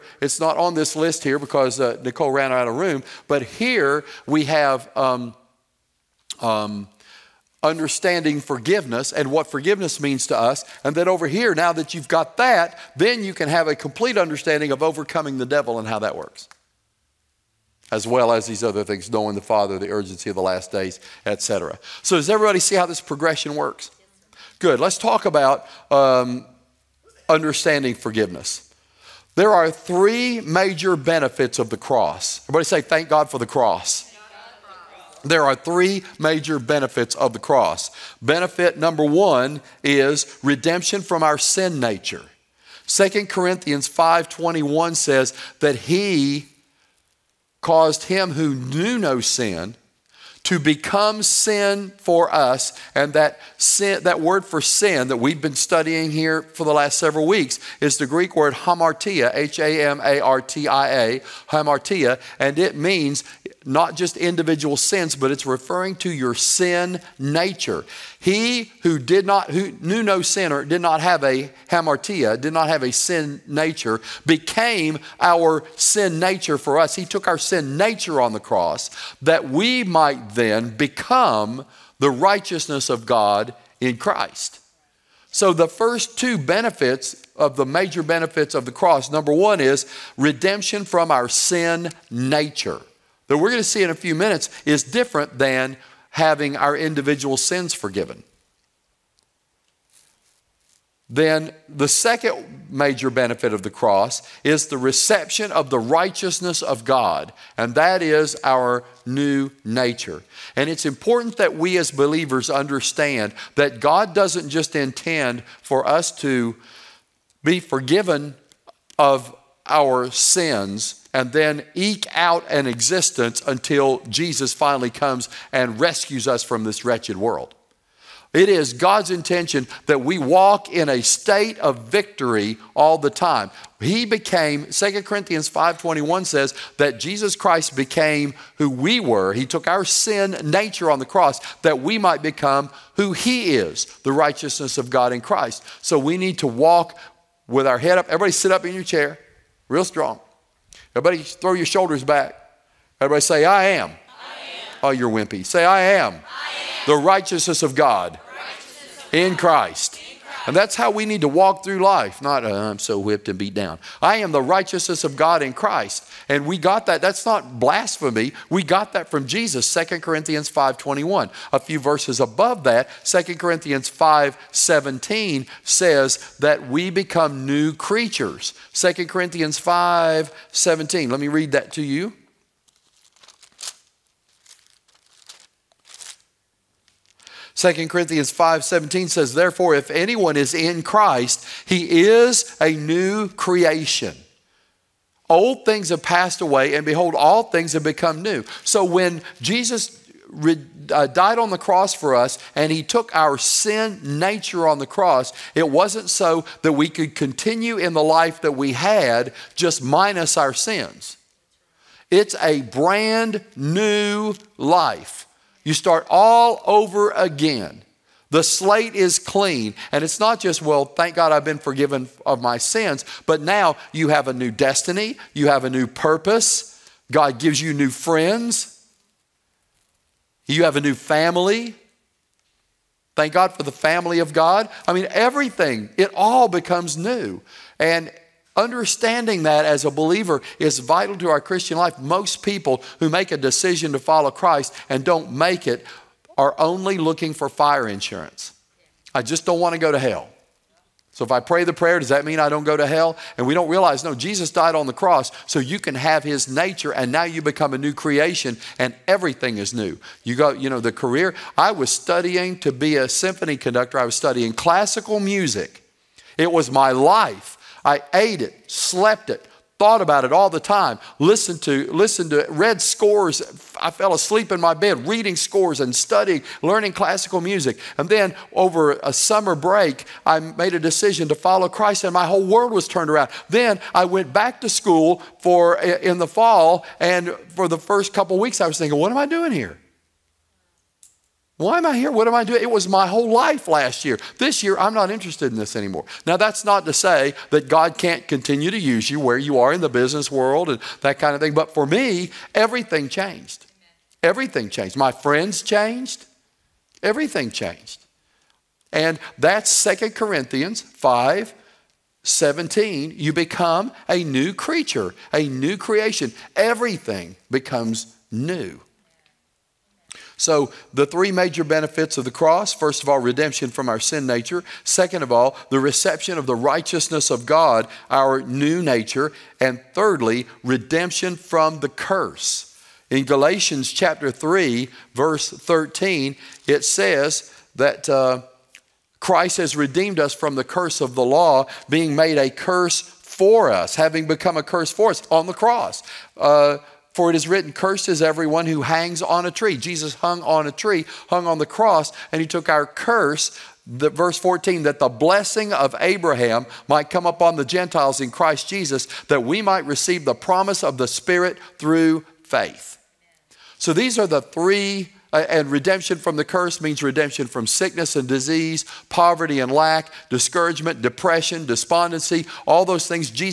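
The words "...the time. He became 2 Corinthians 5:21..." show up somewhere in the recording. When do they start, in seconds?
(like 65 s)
132 s.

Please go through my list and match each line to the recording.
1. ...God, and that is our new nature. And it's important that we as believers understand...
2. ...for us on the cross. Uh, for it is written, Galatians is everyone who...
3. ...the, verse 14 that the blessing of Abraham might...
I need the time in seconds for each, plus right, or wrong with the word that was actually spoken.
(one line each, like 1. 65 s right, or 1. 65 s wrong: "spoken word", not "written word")
1. 106 s right
2. 344 s wrong: "Cursed", not "Galatians"
3. 353 s right.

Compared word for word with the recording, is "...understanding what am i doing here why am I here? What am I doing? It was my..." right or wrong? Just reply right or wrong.
wrong.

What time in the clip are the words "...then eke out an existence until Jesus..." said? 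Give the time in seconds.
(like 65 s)
121 s.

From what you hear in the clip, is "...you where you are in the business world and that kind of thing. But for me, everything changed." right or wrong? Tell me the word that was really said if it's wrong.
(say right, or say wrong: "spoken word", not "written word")
right.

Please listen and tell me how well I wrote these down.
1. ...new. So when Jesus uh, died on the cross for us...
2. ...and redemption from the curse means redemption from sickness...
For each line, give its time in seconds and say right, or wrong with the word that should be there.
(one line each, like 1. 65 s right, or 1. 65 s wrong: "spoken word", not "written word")
1. 198 s right
2. 365 s right.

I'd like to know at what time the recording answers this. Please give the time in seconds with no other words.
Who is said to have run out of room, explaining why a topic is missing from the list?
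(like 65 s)
2 s.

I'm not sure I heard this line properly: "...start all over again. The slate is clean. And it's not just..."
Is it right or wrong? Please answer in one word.
right.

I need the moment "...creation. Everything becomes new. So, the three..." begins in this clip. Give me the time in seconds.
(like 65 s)
315 s.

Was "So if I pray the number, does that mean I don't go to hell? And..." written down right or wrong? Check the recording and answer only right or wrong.
wrong.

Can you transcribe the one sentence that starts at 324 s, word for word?
Second of all, the reception of the righteousness of God, our new nature.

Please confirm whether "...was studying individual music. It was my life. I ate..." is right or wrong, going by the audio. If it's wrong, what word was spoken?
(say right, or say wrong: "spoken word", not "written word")
wrong: "classical", not "individual".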